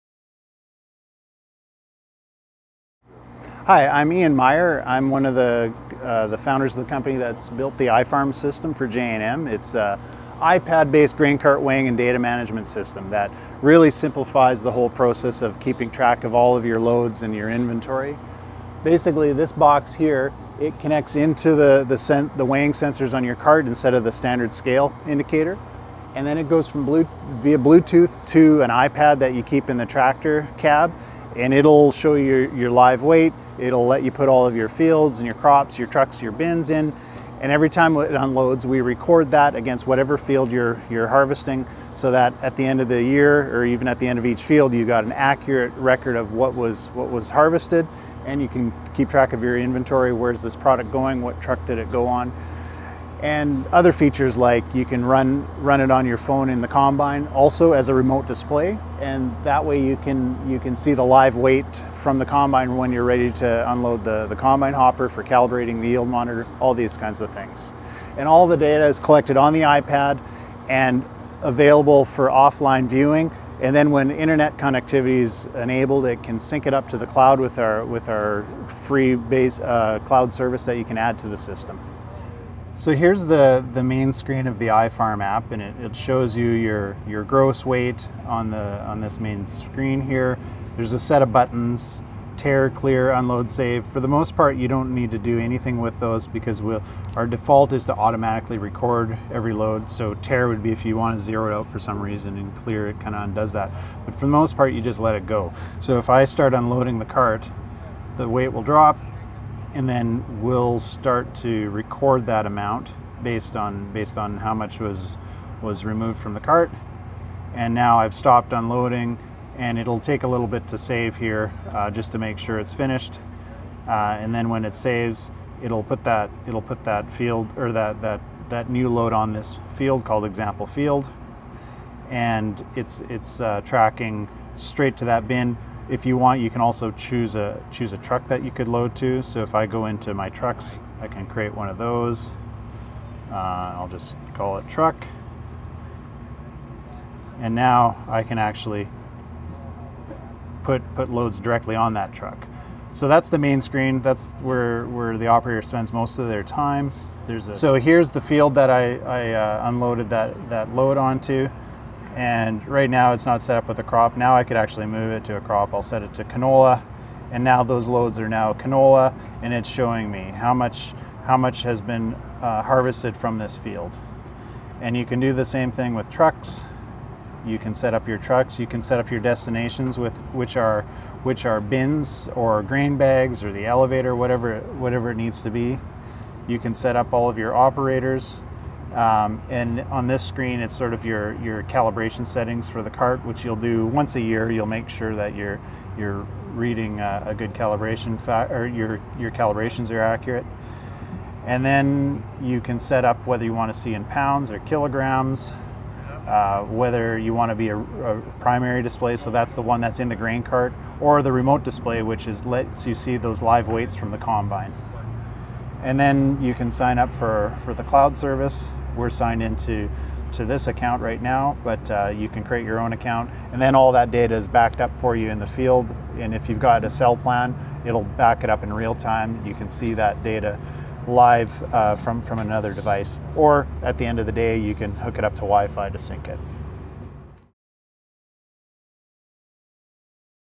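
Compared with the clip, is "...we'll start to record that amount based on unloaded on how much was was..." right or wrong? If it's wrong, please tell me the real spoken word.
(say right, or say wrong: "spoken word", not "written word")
wrong: "based", not "unloaded".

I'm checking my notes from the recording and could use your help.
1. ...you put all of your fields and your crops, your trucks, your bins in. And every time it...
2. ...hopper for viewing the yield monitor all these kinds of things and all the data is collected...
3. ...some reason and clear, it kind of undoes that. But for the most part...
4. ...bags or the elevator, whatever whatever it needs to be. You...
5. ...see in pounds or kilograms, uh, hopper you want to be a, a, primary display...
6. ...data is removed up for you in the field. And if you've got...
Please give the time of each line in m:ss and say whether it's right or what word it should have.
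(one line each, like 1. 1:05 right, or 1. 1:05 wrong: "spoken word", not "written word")
1. 0:34 right
2. 1:04 wrong: "calibrating", not "viewing"
3. 1:41 right
4. 3:02 right
5. 3:23 wrong: "whether", not "hopper"
6. 3:44 wrong: "backed", not "removed".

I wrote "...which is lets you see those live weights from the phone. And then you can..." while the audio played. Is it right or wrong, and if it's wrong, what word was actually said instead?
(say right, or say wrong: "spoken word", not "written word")
wrong: "combine", not "phone".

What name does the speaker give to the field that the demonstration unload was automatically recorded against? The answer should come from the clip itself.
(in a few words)
example field.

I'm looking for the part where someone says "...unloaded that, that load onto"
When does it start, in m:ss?
2:39.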